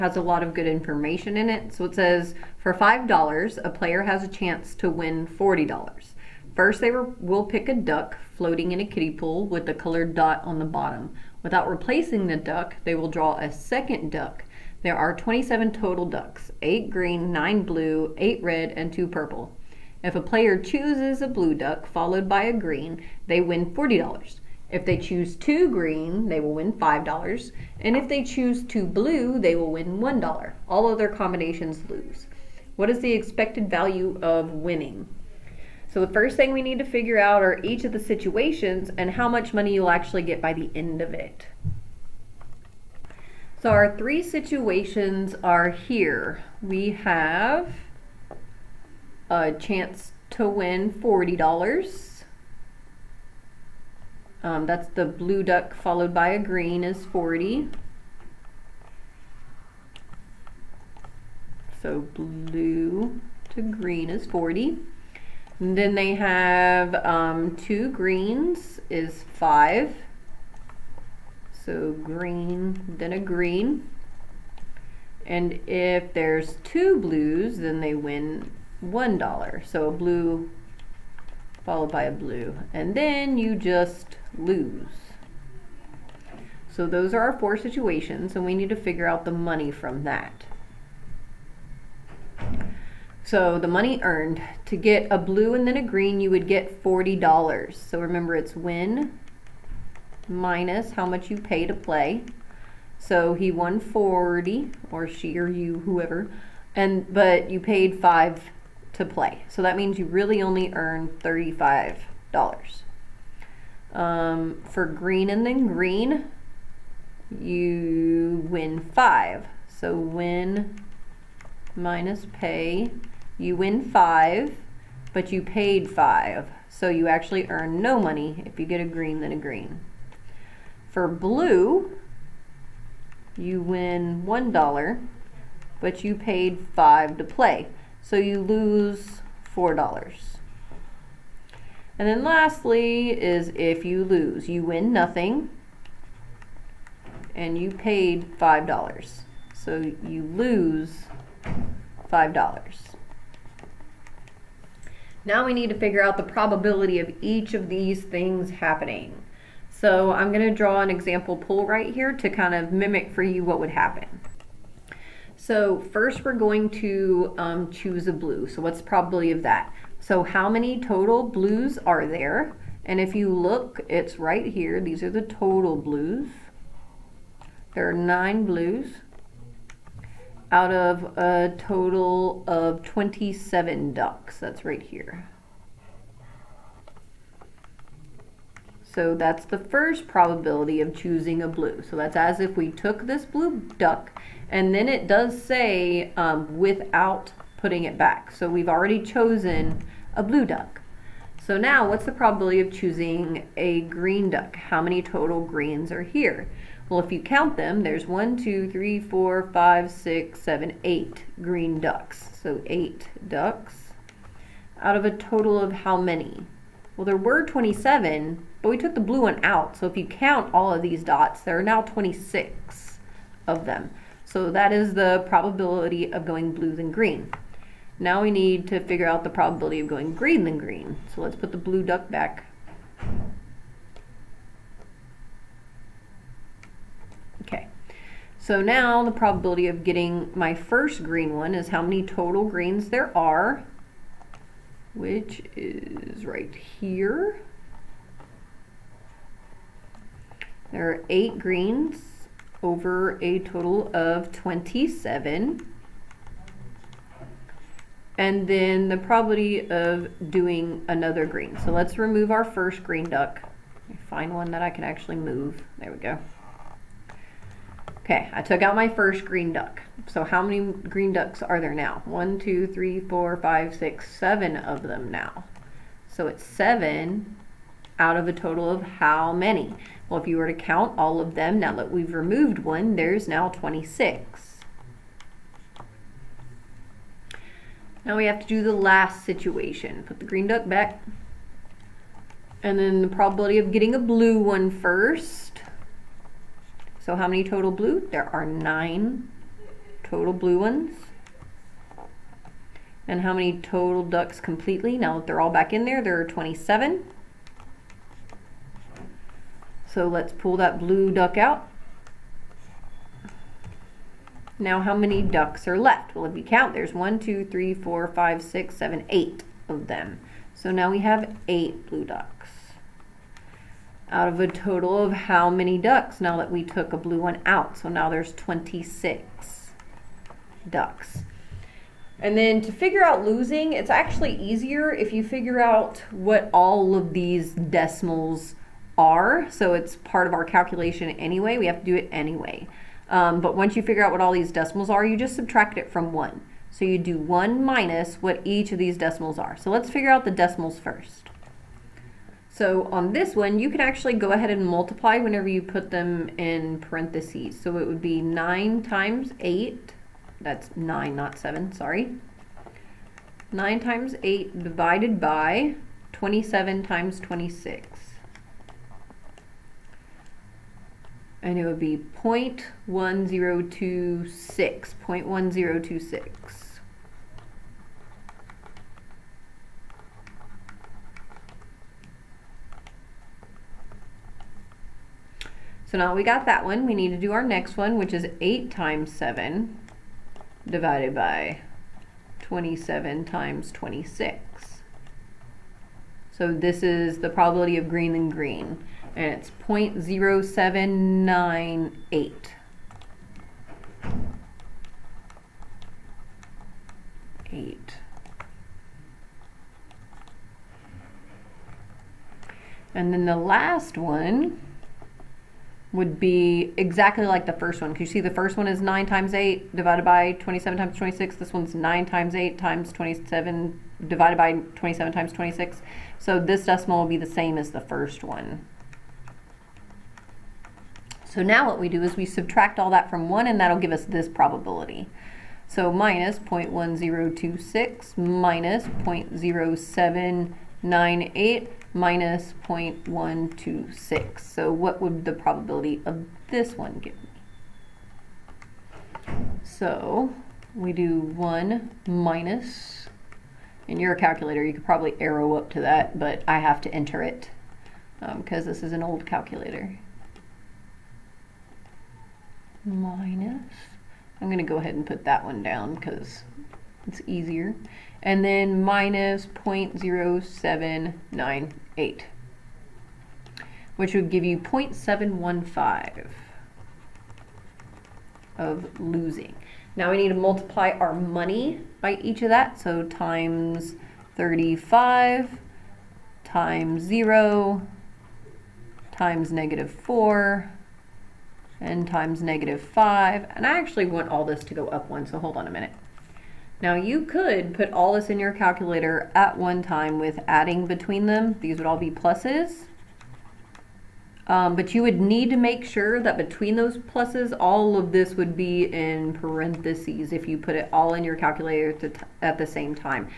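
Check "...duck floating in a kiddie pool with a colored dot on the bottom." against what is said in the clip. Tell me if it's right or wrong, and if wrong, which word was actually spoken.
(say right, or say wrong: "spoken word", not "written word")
right.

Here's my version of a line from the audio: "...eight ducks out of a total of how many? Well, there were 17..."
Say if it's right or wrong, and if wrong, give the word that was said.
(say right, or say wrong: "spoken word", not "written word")
wrong: "27", not "17".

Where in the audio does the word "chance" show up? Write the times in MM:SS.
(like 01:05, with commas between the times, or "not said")
00:04, 00:49.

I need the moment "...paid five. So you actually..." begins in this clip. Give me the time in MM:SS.
02:05.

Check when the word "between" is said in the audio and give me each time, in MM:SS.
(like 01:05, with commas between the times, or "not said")
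08:20, 08:26.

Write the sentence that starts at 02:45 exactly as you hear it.
So first we're going to um, choose a blue.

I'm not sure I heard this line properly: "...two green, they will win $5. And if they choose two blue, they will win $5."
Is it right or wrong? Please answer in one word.
wrong.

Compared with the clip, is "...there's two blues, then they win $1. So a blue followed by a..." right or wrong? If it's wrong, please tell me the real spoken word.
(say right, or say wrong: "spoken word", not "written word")
right.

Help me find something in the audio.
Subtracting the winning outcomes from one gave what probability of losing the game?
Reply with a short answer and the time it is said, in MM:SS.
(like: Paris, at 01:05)
0.715, at 07:54.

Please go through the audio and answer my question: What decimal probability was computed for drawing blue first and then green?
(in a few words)
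0.1026.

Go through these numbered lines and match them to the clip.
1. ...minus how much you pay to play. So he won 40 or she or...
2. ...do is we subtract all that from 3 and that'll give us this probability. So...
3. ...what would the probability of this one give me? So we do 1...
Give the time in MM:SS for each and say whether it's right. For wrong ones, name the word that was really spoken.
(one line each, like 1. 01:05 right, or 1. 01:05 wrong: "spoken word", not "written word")
1. 01:40 right
2. 07:11 wrong: "1", not "3"
3. 07:24 right.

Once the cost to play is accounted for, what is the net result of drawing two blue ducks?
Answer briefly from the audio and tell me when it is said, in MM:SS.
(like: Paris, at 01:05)
lose $4, at 02:18.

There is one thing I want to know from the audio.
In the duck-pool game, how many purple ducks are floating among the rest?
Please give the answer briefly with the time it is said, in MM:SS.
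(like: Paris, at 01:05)
2, at 00:18.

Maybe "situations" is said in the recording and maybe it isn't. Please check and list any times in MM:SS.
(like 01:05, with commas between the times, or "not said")
00:37, 00:44, 01:27, 04:49.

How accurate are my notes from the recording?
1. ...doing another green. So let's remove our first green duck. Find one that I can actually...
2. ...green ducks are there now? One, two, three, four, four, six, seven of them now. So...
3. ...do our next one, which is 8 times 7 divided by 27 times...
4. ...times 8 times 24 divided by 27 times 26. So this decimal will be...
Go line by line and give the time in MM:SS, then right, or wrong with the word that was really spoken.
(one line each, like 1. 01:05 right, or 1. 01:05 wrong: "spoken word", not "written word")
1. 04:20 right
2. 04:30 wrong: "five", not "four"
3. 06:27 right
4. 07:02 wrong: "27", not "24".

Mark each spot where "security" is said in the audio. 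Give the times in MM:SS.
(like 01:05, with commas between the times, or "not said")
not said.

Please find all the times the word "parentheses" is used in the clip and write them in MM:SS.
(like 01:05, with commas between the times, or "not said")
05:56, 08:29.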